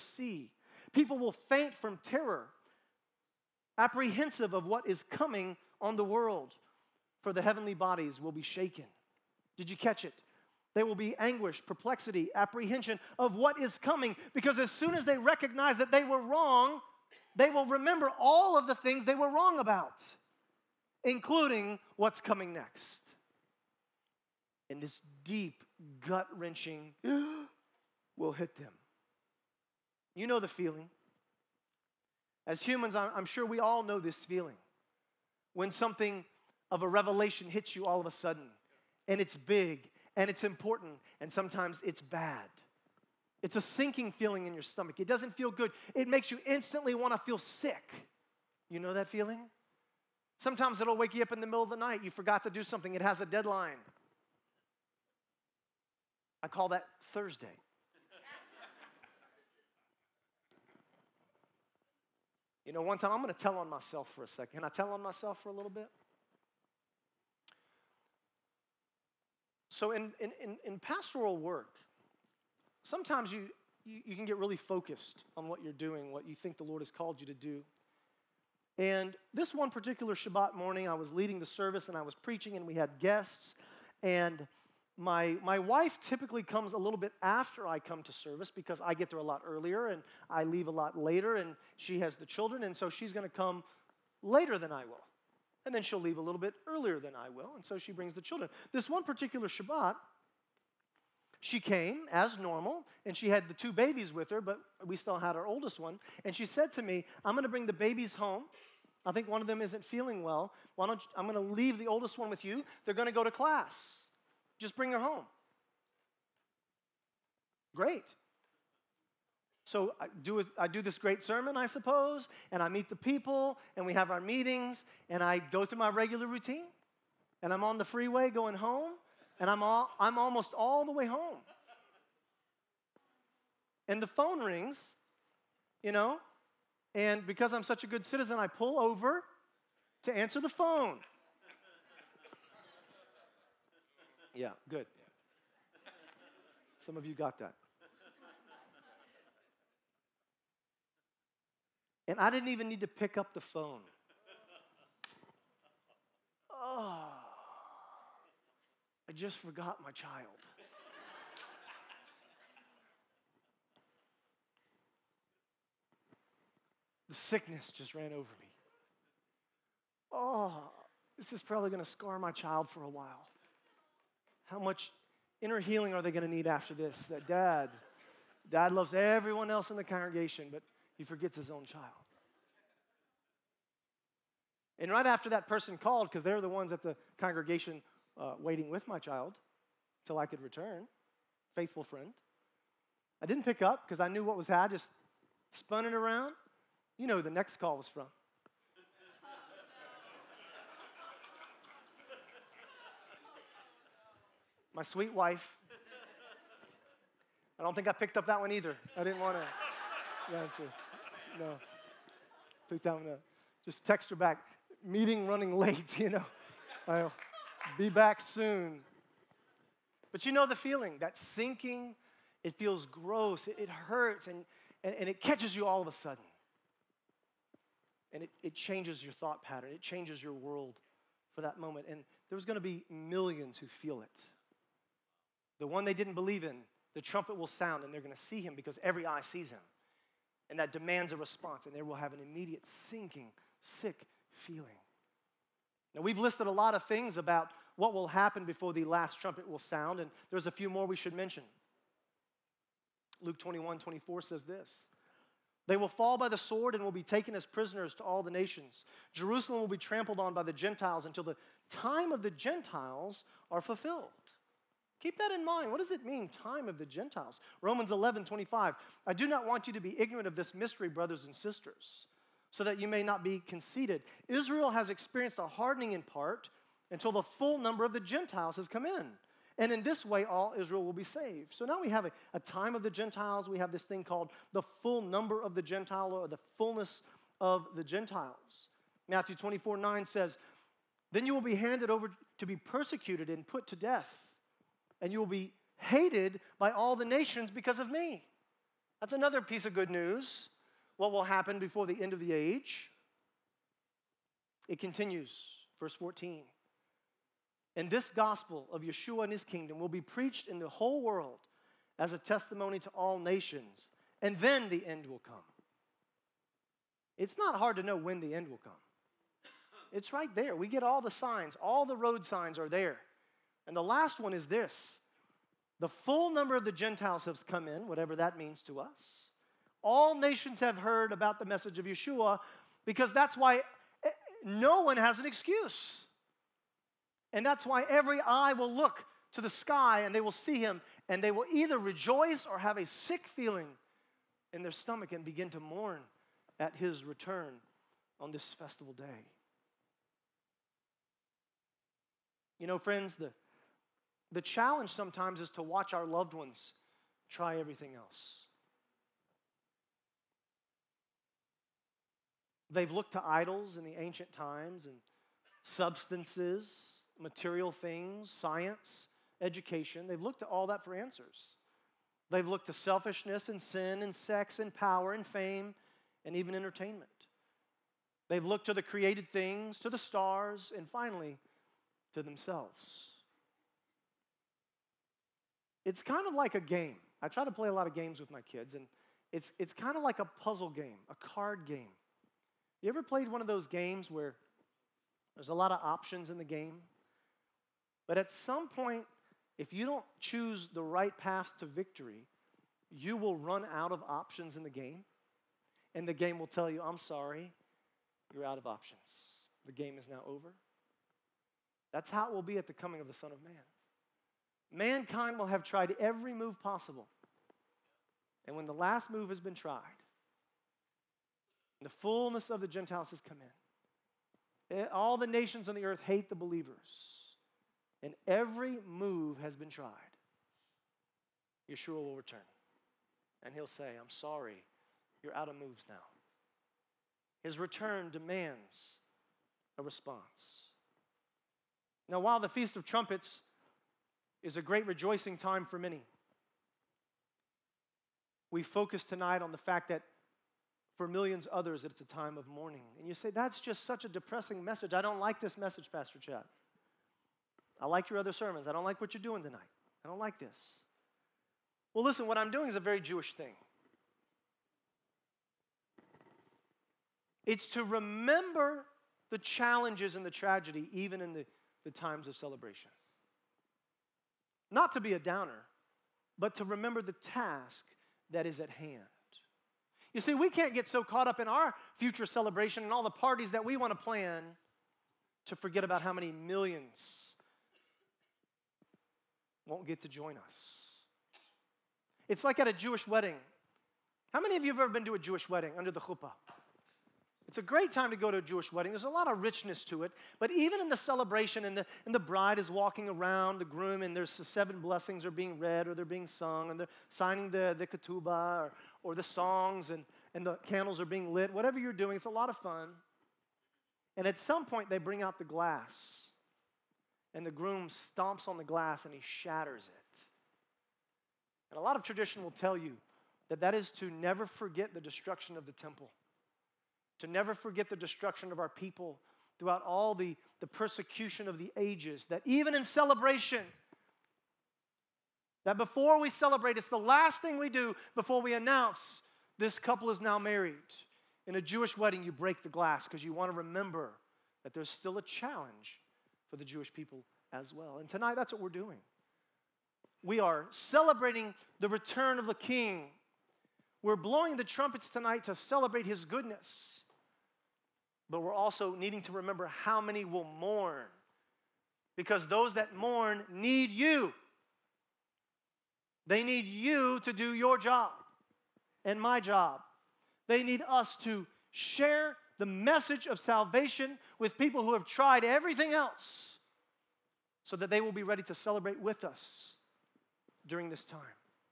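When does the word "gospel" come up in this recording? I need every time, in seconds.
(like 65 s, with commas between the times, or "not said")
308 s.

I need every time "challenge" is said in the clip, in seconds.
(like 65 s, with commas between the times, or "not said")
354 s, 469 s, 545 s.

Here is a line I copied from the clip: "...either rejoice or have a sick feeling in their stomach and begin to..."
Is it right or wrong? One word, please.
right.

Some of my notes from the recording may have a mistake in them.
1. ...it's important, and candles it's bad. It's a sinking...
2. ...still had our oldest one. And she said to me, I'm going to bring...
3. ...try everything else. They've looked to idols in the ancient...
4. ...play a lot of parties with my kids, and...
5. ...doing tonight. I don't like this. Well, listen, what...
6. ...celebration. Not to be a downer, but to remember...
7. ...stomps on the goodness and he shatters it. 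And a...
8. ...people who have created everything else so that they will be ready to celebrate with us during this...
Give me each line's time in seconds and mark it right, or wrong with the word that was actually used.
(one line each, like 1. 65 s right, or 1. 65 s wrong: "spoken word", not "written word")
1. 40 s wrong: "sometimes", not "candles"
2. 104 s right
3. 357 s right
4. 387 s wrong: "games", not "parties"
5. 459 s right
6. 472 s right
7. 517 s wrong: "glass", not "goodness"
8. 574 s wrong: "tried", not "created".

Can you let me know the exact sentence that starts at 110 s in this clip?
Why don't you, I'm going to leave the oldest one with you.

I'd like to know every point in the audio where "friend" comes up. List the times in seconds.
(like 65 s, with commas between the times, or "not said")
191 s, 352 s.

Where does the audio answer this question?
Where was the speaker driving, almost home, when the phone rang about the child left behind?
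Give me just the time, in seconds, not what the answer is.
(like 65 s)
127 s.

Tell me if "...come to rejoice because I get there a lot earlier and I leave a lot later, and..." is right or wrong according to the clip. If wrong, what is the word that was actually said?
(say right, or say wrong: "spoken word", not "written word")
wrong: "service", not "rejoice".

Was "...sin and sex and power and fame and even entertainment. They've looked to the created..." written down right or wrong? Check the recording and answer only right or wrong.
right.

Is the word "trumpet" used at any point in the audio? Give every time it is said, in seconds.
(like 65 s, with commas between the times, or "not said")
237 s, 249 s, 442 s, 554 s.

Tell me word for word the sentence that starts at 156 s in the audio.
Oh, I just forgot my child.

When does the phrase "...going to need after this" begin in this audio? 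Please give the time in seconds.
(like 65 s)
176 s.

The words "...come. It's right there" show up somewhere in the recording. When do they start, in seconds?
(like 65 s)
318 s.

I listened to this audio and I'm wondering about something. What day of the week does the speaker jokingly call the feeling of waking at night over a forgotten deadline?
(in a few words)
Thursday.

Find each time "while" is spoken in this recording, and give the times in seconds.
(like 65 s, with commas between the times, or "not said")
172 s, 442 s.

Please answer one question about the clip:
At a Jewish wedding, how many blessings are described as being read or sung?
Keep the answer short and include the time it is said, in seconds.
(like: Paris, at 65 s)
7, at 504 s.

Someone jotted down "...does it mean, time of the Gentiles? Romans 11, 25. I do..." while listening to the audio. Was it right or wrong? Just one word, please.
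right.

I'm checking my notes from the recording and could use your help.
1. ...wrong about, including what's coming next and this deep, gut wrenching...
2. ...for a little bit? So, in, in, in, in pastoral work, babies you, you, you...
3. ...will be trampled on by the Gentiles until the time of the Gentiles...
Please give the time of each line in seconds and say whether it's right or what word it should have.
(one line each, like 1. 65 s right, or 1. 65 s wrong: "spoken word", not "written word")
1. 19 s right
2. 65 s wrong: "sometimes", not "babies"
3. 259 s right.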